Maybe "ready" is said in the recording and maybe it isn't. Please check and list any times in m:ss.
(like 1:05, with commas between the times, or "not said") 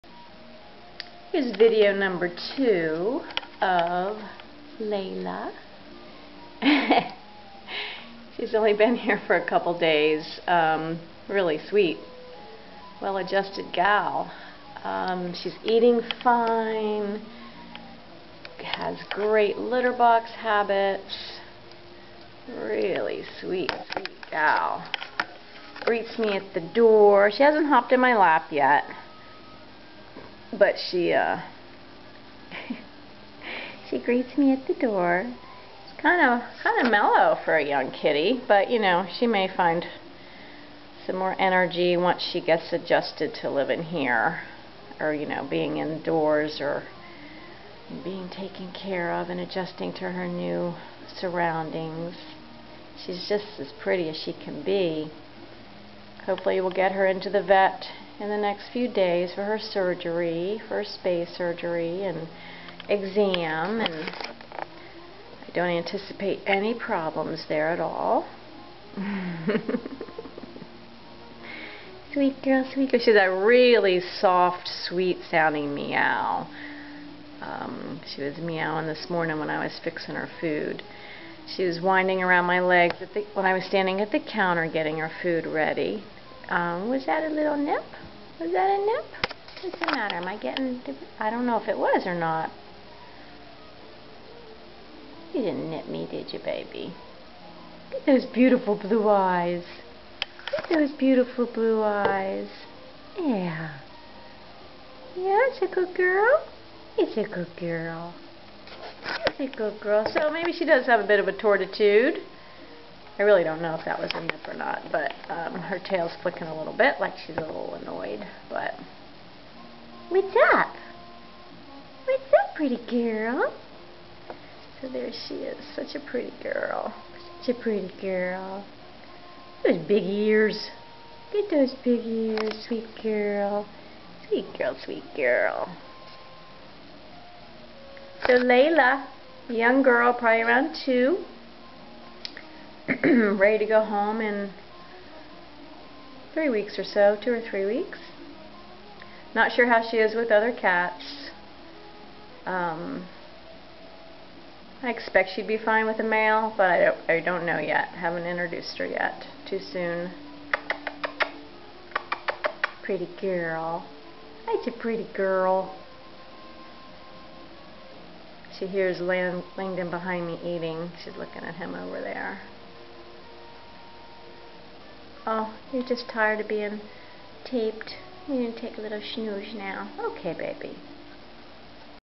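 1:25, 2:23.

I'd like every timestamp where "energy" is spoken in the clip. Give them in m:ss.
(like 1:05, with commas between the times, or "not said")
0:41.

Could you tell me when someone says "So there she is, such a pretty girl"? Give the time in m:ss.
2:04.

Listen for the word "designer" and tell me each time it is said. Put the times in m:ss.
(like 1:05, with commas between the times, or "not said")
not said.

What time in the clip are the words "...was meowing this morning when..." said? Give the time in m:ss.
1:18.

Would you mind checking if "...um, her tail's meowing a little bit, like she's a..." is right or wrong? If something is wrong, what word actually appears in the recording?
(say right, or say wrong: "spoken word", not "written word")
wrong: "flicking", not "meowing".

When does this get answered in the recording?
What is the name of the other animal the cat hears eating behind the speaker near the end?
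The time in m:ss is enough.
2:49.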